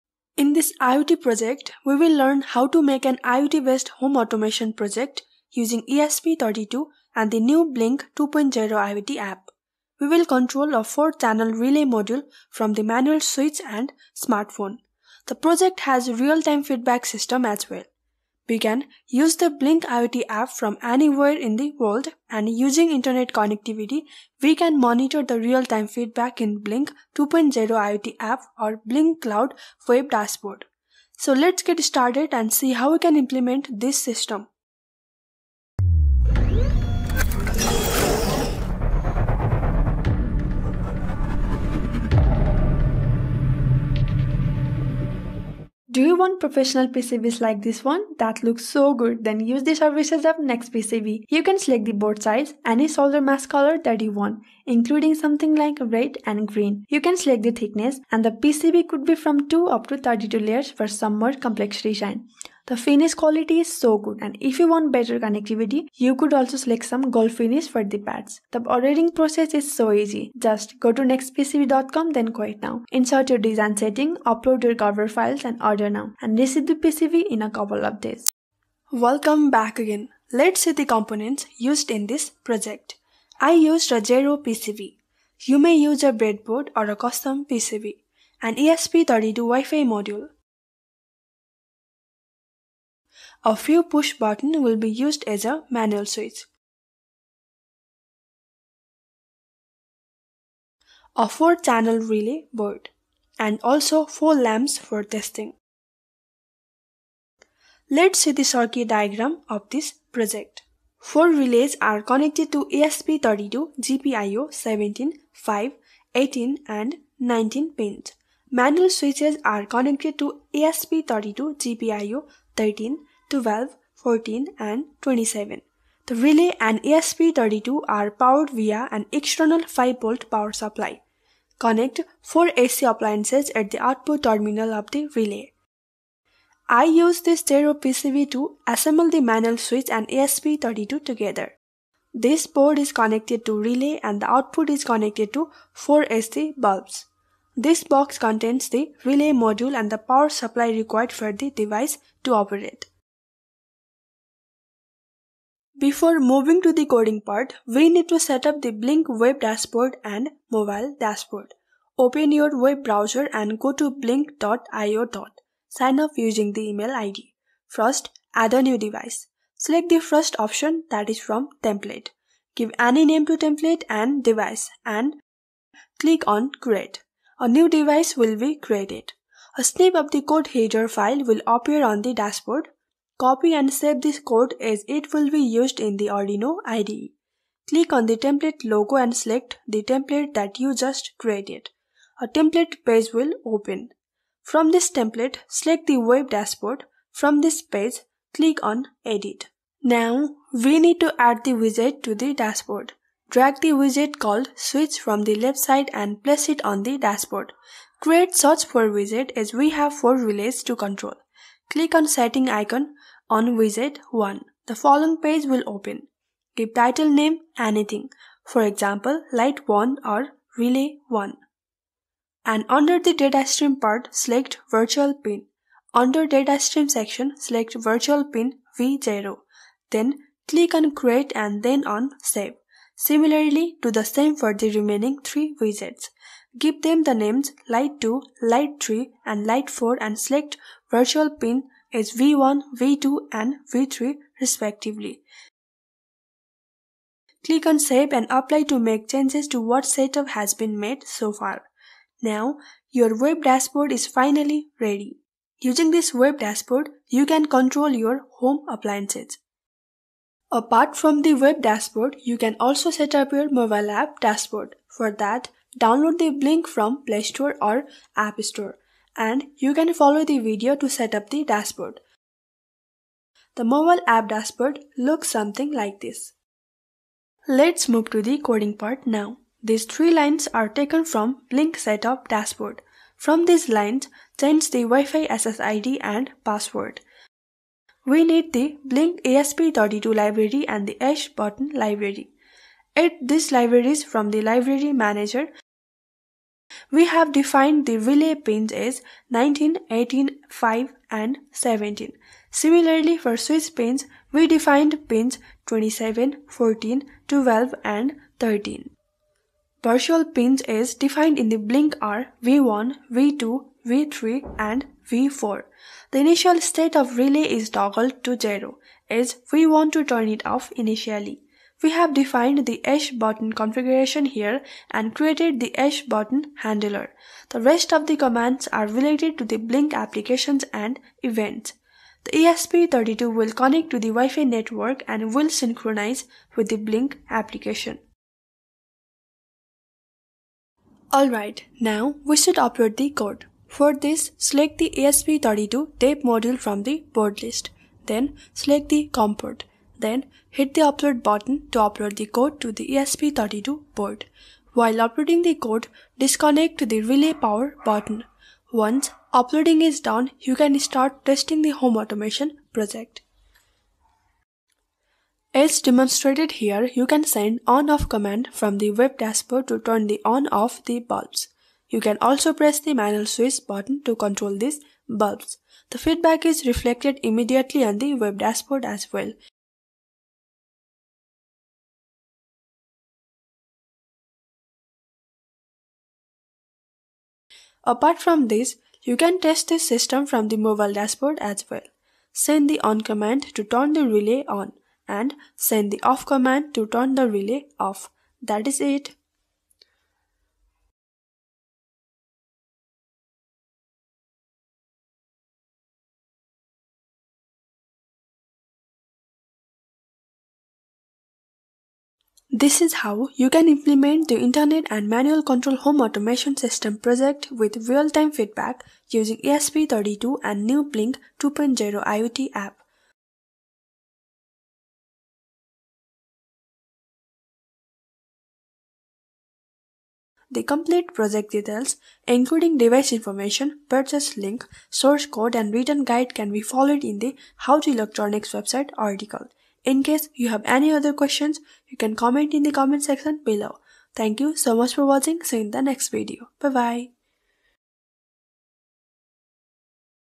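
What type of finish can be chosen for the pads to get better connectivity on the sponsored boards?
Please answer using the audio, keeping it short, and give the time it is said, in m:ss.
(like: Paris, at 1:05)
gold finish, at 1:07.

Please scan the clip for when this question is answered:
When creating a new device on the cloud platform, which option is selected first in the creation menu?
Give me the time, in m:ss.
2:51.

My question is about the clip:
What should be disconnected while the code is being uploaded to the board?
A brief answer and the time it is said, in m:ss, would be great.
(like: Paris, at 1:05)
relay power, at 5:57.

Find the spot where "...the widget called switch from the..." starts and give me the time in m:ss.
3:23.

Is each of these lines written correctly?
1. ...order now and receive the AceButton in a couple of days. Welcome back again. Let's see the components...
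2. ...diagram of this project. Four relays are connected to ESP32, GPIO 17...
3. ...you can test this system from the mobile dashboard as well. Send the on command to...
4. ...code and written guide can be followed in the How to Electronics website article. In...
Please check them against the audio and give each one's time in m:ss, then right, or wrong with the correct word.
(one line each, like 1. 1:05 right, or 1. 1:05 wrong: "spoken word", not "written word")
1. 1:15 wrong: "PCB", not "AceButton"
2. 1:48 right
3. 6:29 right
4. 7:15 right.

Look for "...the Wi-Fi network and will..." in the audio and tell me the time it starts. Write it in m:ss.
5:33.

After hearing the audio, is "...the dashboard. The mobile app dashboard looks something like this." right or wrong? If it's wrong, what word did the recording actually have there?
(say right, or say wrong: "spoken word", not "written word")
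right.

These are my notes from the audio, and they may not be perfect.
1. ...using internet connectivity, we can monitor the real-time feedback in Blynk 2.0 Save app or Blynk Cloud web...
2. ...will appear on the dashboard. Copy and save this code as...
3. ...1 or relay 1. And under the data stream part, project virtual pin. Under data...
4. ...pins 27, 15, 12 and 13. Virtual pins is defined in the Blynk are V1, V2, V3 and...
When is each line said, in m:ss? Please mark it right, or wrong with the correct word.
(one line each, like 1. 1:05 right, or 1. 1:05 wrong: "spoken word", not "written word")
1. 0:22 wrong: "IoT", not "Save"
2. 3:01 right
3. 3:39 wrong: "select", not "project"
4. 5:05 wrong: "14", not "15".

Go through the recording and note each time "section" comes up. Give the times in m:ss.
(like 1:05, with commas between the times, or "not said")
3:46, 7:23.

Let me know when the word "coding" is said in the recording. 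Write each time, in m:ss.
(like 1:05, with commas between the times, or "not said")
2:36, 4:38.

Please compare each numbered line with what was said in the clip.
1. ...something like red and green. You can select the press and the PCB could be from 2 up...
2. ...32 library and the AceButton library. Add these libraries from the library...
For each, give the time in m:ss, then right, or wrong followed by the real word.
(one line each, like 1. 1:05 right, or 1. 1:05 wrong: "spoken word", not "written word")
1. 0:55 wrong: "thickness", not "press"
2. 4:49 right.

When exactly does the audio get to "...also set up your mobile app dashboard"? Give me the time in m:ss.
4:22.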